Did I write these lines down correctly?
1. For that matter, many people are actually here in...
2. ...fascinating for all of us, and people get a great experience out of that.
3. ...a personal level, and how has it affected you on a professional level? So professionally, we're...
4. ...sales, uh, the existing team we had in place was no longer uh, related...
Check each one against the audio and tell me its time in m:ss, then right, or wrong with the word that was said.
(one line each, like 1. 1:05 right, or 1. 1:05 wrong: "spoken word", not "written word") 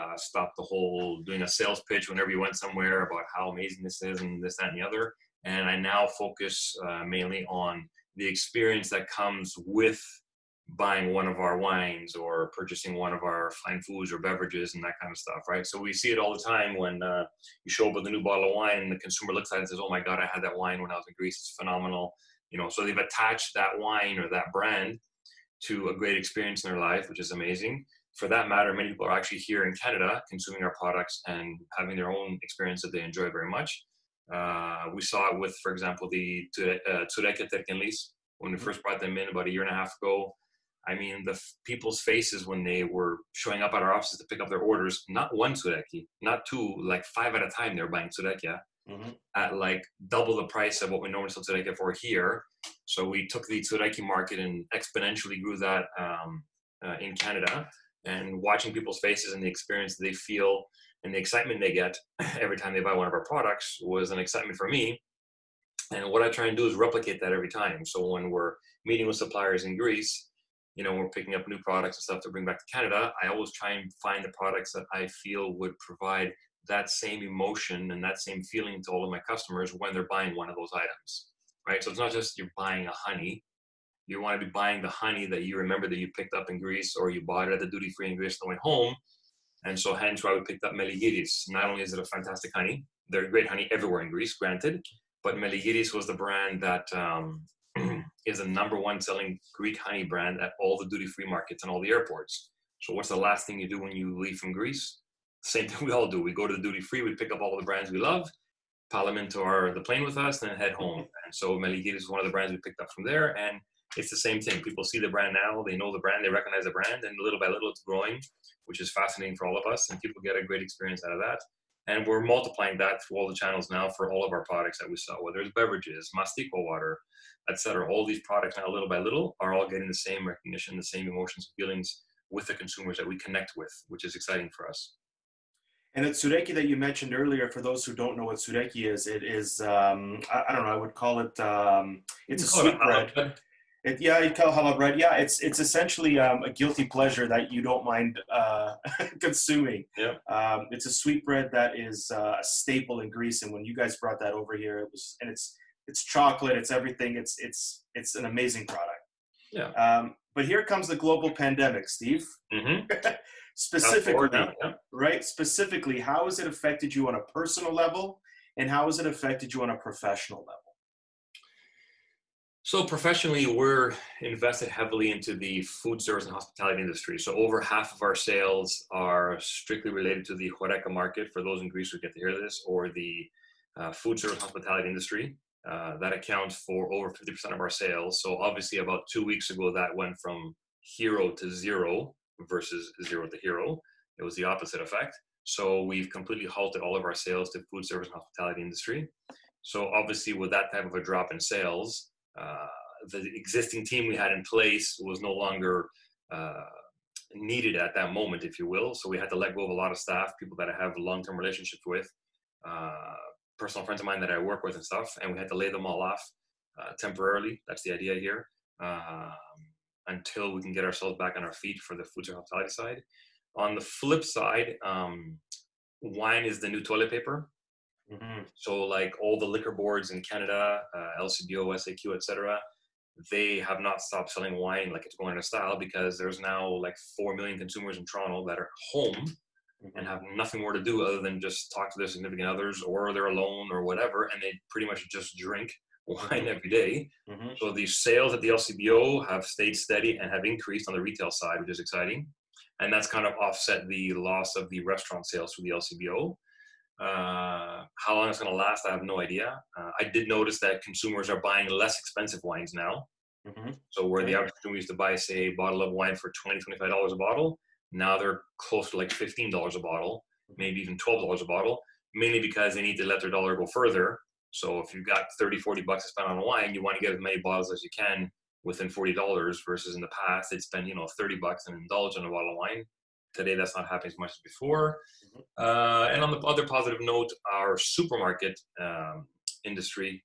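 1. 0:28 right
2. 1:58 right
3. 2:47 right
4. 3:21 wrong: "needed", not "related".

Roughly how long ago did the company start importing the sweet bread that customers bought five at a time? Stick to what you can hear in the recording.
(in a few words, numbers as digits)
a year and a half.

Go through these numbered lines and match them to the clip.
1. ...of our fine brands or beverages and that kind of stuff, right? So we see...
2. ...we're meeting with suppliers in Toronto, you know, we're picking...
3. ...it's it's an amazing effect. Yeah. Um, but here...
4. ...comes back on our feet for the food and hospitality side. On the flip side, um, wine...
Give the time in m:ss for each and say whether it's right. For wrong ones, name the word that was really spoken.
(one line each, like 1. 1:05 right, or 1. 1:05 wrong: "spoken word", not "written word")
1. 0:13 wrong: "foods", not "brands"
2. 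1:08 wrong: "Greece", not "Toronto"
3. 2:37 wrong: "product", not "effect"
4. 3:40 wrong: "ourselves", not "comes".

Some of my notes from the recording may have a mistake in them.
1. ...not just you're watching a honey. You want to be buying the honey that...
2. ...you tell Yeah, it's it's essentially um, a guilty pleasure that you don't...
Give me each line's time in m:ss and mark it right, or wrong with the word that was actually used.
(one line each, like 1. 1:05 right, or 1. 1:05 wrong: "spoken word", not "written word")
1. 1:21 wrong: "buying", not "watching"
2. 2:24 right.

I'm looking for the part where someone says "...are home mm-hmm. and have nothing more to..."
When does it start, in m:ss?
3:58.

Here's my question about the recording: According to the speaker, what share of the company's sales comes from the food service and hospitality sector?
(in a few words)
over 50%.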